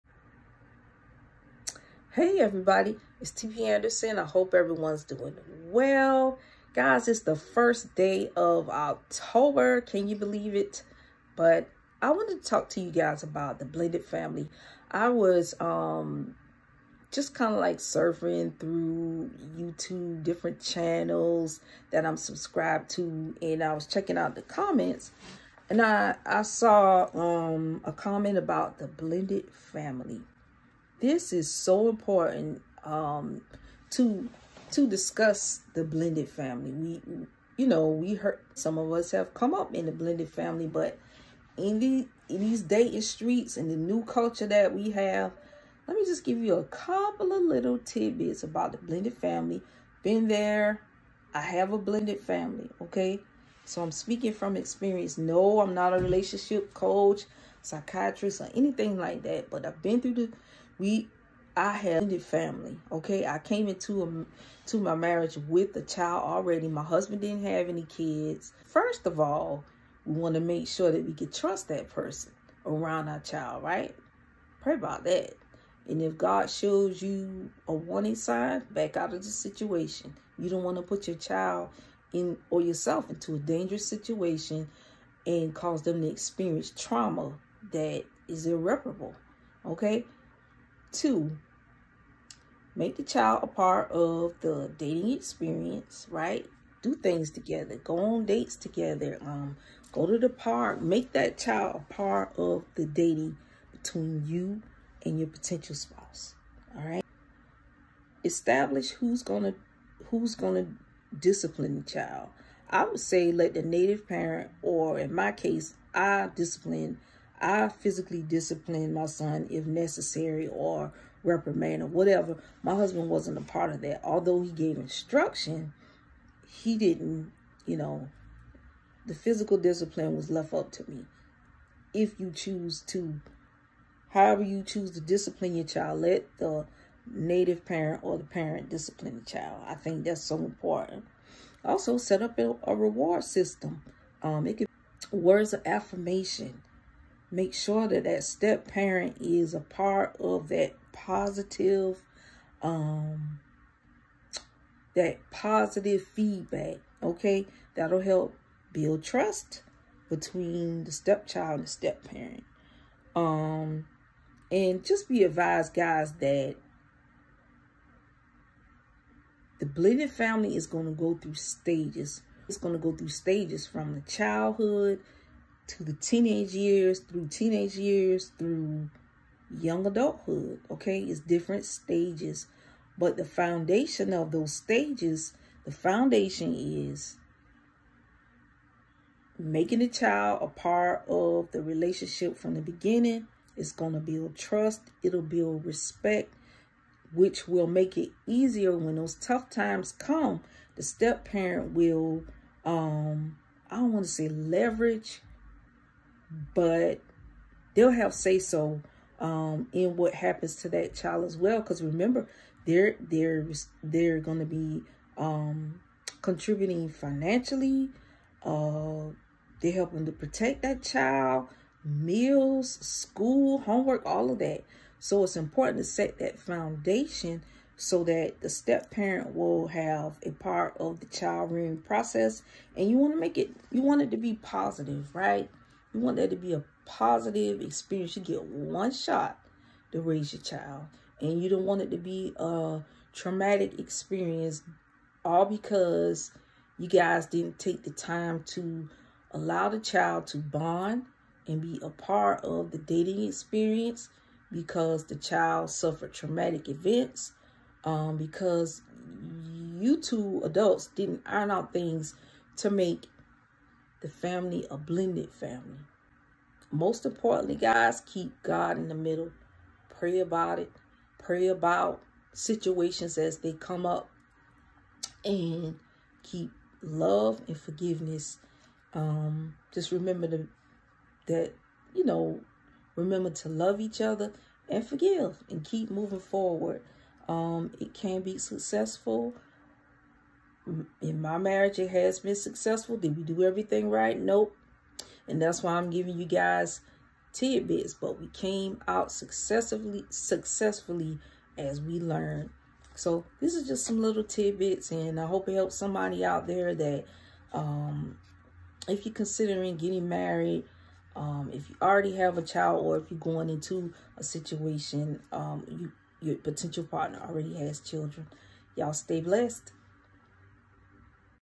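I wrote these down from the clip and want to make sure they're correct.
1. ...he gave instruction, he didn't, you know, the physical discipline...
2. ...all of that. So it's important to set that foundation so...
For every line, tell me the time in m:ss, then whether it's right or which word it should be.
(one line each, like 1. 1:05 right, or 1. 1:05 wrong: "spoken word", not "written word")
1. 2:04 right
2. 3:44 right.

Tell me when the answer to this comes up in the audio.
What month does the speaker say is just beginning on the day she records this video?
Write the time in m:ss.
0:08.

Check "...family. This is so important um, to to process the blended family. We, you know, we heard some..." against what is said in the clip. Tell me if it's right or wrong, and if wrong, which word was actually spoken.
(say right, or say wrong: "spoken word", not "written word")
wrong: "discuss", not "process".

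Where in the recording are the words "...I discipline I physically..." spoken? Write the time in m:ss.
1:55.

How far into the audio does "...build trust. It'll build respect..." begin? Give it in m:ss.
3:13.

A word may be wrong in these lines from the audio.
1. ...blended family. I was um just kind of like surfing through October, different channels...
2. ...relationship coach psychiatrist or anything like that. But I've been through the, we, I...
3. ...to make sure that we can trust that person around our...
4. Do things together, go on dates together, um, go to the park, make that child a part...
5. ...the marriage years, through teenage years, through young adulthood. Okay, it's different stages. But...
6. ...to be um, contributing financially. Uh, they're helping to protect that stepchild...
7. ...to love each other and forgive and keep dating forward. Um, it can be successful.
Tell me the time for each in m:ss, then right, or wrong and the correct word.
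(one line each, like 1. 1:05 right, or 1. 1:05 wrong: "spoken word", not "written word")
1. 0:13 wrong: "YouTube", not "October"
2. 0:55 right
3. 1:10 right
4. 1:36 right
5. 2:55 wrong: "teenage", not "marriage"
6. 3:34 wrong: "child", not "stepchild"
7. 4:43 wrong: "moving", not "dating".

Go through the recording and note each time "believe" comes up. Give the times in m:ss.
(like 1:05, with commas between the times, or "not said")
0:10.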